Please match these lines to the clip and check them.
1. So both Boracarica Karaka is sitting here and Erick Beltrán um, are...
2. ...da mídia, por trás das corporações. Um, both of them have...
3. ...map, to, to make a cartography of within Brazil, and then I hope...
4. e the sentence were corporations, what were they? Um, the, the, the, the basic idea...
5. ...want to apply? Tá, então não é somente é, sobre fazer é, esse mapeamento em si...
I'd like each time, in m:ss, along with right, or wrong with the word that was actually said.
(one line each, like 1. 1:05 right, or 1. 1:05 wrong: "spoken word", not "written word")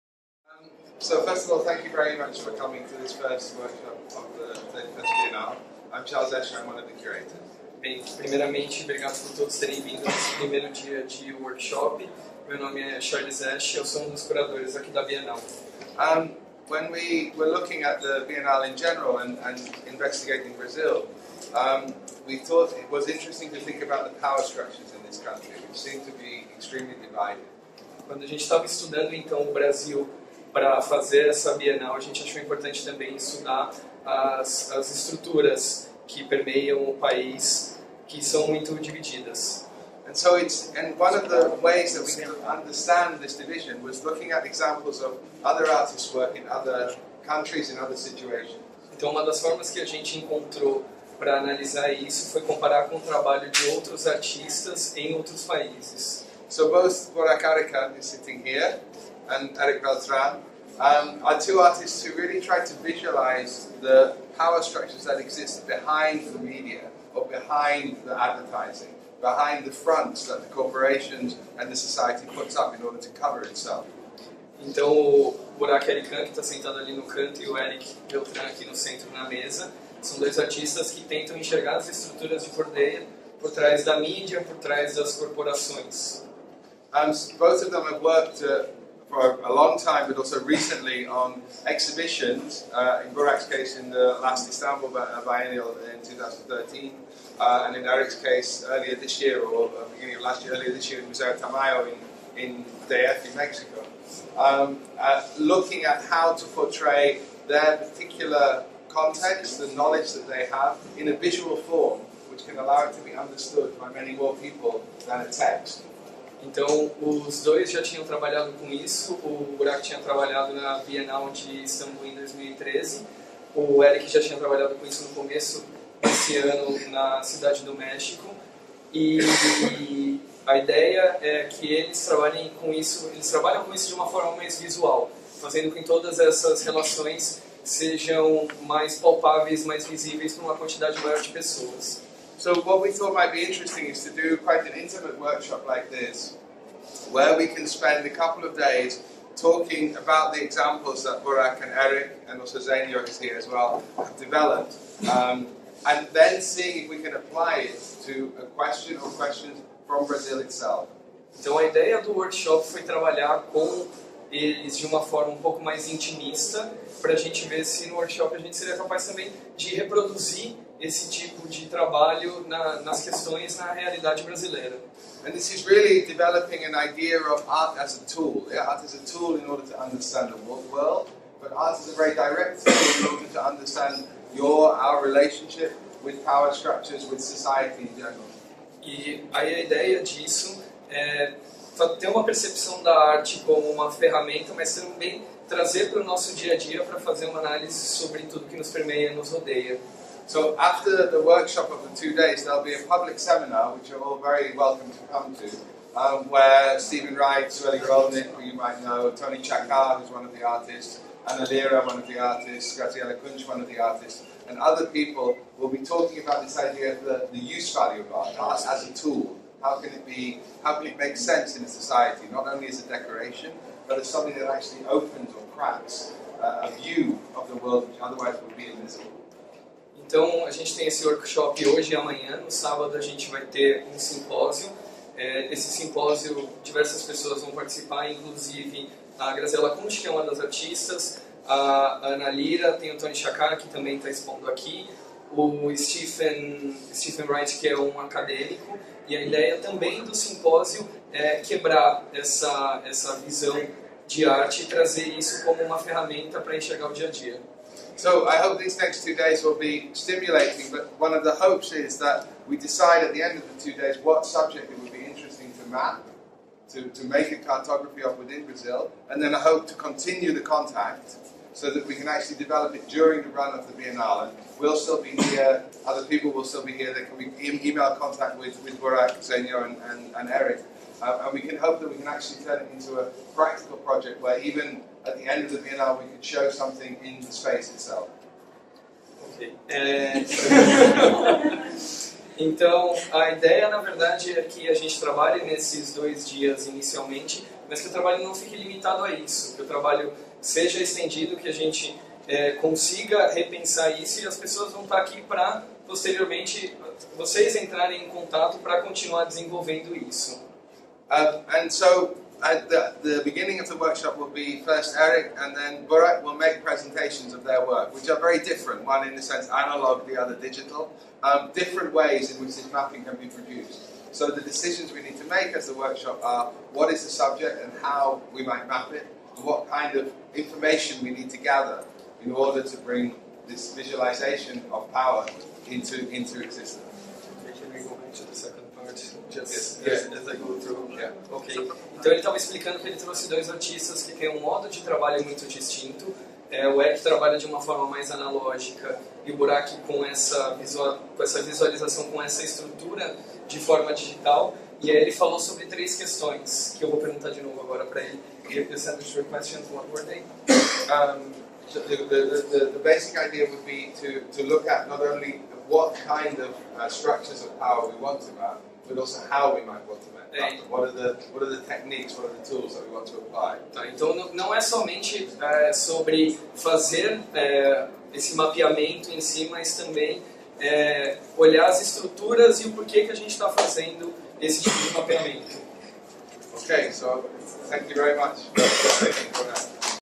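1. 0:56 right
2. 1:23 right
3. 4:25 right
4. 5:58 wrong: "questions", not "corporations"
5. 6:12 right.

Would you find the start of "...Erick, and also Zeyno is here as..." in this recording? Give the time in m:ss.
2:31.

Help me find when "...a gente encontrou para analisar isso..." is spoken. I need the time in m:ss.
0:49.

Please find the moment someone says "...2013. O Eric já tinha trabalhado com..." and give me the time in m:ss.
2:02.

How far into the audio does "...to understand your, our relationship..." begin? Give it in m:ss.
3:03.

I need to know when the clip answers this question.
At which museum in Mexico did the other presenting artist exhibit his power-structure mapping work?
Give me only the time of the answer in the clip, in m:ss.
1:41.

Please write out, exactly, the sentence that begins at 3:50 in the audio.
Então, a gente tem esse workshop hoje e amanhã.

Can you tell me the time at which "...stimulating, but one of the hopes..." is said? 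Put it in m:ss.
4:19.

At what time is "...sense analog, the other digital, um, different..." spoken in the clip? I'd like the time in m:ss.
5:19.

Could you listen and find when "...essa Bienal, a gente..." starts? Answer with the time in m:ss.
0:31.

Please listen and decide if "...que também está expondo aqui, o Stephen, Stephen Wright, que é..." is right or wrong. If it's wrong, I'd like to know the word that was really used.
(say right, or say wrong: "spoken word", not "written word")
right.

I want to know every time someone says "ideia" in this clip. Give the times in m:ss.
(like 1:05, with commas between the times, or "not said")
2:10, 2:41, 3:09, 4:09, 4:53.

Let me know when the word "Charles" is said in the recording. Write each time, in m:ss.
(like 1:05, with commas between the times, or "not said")
0:06, 0:13.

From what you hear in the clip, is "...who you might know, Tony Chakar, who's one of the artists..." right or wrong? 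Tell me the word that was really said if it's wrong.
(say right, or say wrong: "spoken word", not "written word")
right.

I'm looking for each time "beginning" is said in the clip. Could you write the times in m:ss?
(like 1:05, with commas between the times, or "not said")
1:39, 5:13.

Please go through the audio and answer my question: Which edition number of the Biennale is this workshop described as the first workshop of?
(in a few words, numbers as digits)
31st.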